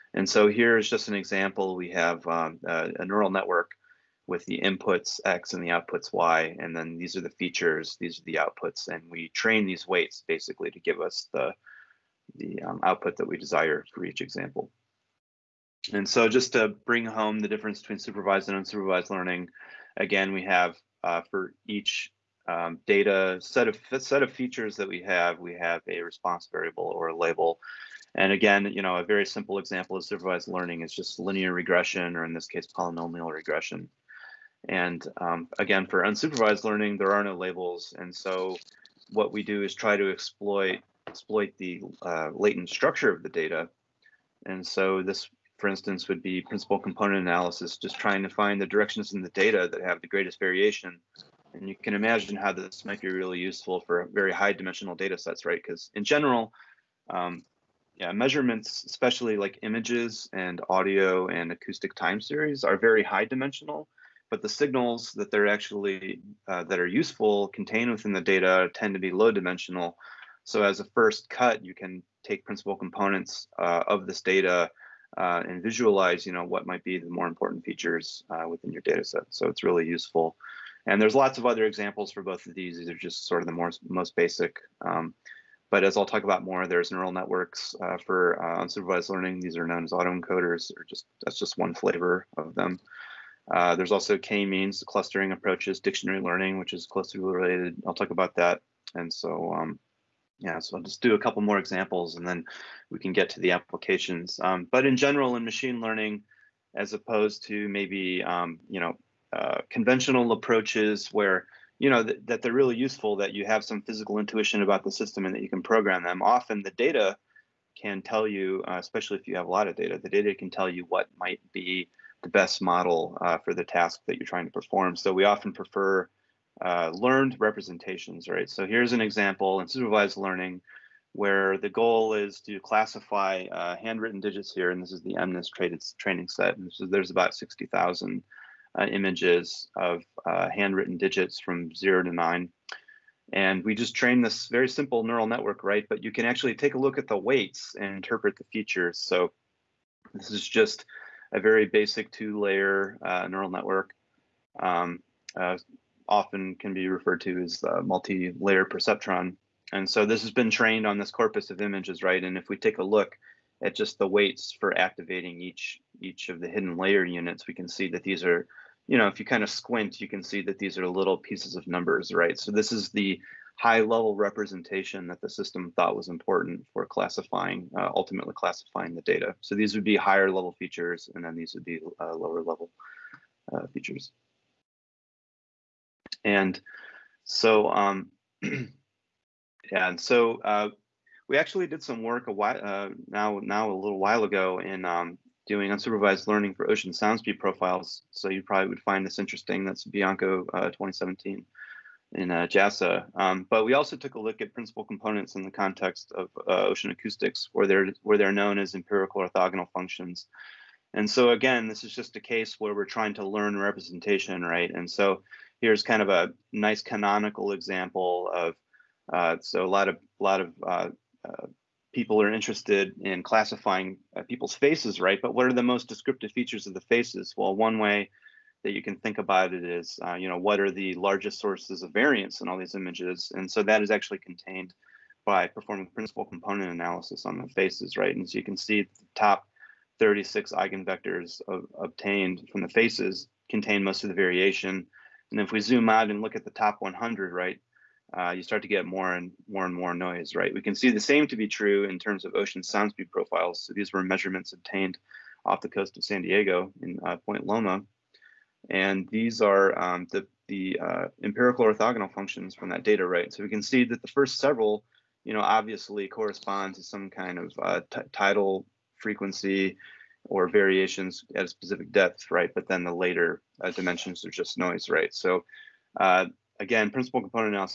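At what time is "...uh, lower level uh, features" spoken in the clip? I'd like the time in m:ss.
3:01.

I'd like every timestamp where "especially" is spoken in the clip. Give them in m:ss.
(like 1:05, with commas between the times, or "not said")
0:58, 1:58.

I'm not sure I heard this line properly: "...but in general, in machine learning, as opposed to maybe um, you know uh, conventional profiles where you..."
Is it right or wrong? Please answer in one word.
wrong.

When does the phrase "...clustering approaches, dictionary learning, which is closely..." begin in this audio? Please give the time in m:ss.
1:34.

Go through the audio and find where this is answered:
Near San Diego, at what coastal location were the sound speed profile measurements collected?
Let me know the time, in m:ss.
4:17.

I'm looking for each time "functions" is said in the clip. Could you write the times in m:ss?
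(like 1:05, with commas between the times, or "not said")
3:29, 4:22.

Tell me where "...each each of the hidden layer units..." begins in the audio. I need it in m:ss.
2:45.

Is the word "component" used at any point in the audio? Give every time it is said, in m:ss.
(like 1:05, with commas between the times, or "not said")
0:46, 1:12, 3:24, 3:56, 4:37.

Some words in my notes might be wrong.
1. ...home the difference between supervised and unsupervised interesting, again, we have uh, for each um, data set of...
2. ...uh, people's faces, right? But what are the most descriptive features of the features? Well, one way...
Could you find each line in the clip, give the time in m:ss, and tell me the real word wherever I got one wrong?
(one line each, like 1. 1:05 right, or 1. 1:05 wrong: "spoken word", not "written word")
1. 0:17 wrong: "learning", not "interesting"
2. 3:44 wrong: "faces", not "features".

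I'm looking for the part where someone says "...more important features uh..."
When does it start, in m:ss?
1:17.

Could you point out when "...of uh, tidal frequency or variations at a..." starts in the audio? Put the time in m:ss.
4:27.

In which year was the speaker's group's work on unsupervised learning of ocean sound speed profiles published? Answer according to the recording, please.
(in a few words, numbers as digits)
2017.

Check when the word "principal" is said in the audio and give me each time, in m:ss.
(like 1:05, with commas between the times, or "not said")
0:46, 1:12, 3:24, 3:55, 4:36.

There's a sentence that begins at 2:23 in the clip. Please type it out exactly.
And we just train this very simple neural network, right?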